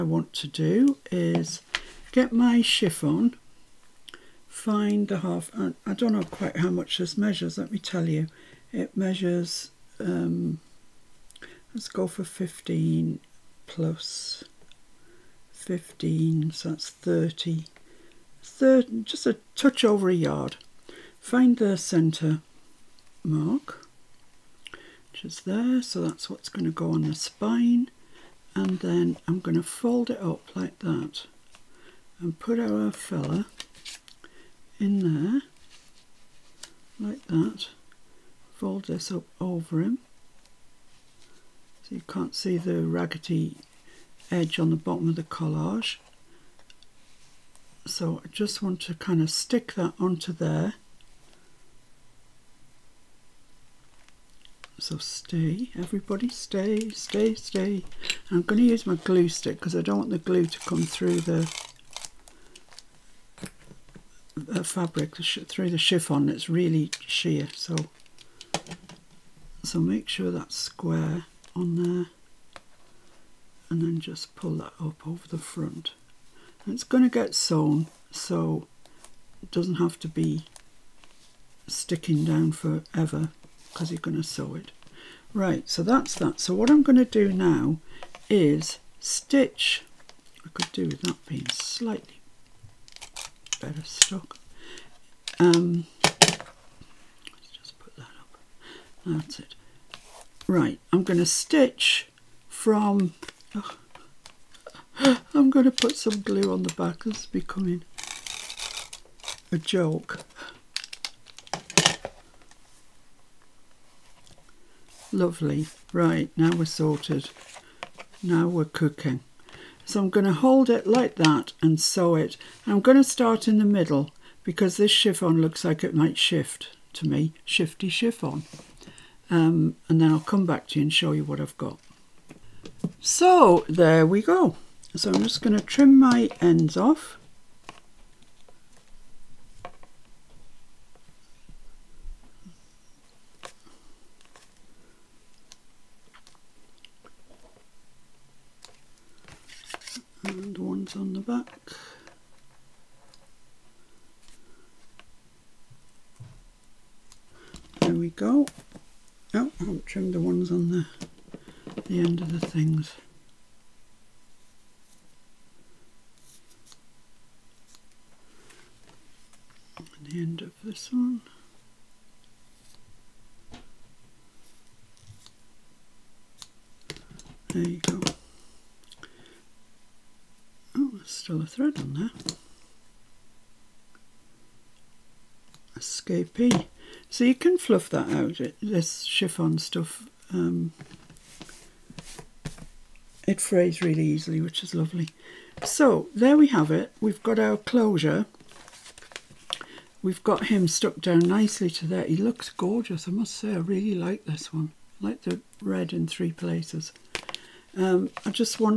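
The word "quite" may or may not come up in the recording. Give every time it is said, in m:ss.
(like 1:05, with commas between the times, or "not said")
0:06.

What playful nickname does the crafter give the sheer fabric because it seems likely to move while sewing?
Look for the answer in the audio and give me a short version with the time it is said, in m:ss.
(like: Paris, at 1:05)
Shifty chiffon, at 2:07.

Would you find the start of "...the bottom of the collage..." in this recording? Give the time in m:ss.
0:44.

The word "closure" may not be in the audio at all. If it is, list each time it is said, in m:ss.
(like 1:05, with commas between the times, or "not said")
3:17.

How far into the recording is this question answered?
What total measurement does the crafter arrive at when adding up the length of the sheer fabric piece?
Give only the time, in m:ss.
0:16.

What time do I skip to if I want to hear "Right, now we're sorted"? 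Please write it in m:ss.
1:55.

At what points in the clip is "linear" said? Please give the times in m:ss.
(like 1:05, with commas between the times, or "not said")
not said.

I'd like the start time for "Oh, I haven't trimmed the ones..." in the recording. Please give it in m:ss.
2:39.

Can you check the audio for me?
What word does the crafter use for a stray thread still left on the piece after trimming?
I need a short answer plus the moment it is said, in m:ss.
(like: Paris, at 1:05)
Escapee, at 3:05.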